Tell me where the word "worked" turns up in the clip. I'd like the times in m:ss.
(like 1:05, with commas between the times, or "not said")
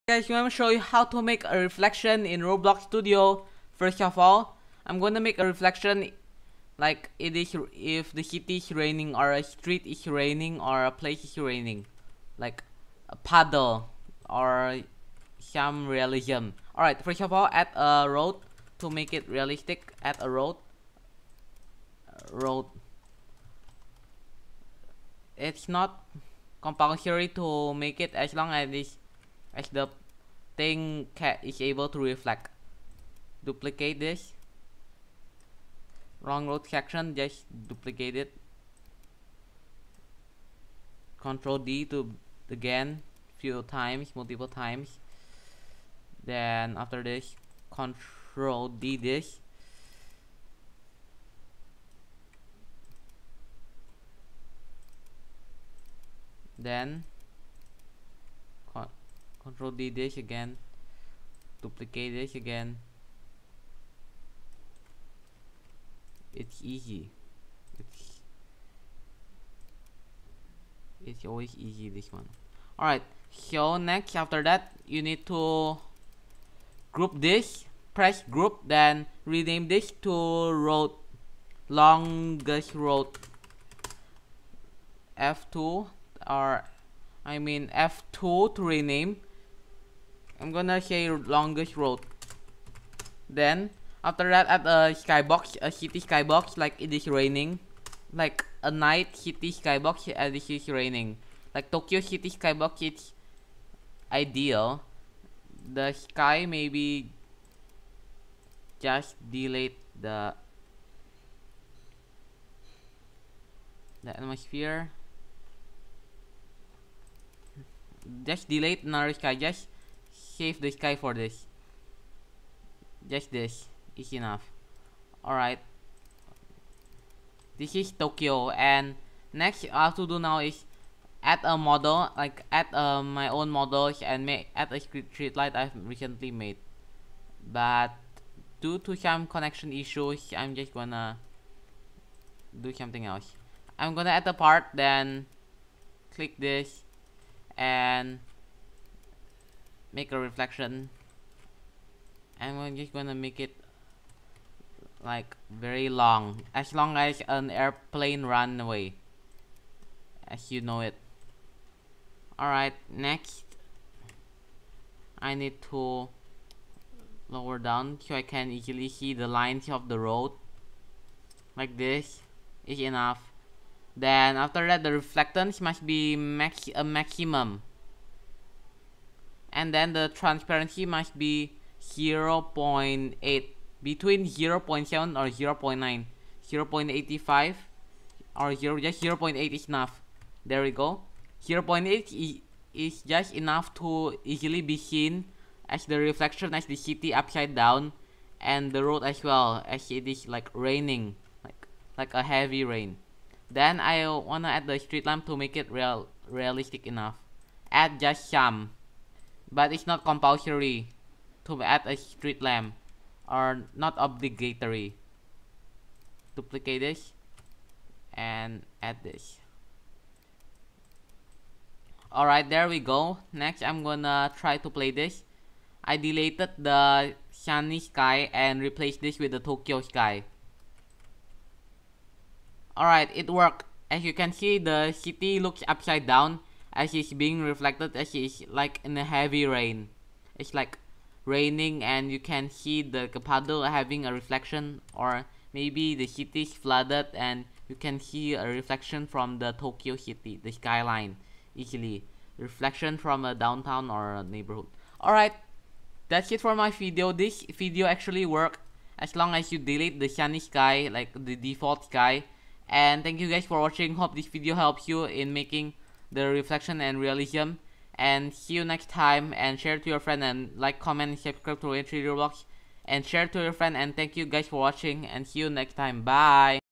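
3:53, 4:18.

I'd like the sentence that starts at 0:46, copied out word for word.
Then after this, Control D this.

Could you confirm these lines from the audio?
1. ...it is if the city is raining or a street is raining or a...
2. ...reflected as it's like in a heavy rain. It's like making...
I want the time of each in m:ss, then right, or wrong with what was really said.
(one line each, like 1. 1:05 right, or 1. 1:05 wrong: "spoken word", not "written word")
1. 0:07 right
2. 3:57 wrong: "raining", not "making".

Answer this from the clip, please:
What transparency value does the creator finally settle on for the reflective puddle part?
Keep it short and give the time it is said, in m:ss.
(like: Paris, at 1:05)
0.8, at 3:09.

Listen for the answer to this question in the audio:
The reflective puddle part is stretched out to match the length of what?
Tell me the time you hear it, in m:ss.
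2:37.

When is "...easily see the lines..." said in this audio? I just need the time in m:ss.
2:48.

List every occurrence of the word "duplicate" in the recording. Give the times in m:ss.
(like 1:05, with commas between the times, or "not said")
0:33, 0:37, 1:01, 3:36.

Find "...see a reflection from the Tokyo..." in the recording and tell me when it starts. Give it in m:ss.
4:07.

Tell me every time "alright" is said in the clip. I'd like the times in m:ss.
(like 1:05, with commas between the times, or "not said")
0:16, 1:12, 2:05, 2:42, 3:42, 3:52, 4:15.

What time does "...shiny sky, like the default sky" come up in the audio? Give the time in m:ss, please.
4:20.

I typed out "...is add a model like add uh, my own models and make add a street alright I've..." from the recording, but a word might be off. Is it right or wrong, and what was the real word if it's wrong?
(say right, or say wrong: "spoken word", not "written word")
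wrong: "light", not "alright".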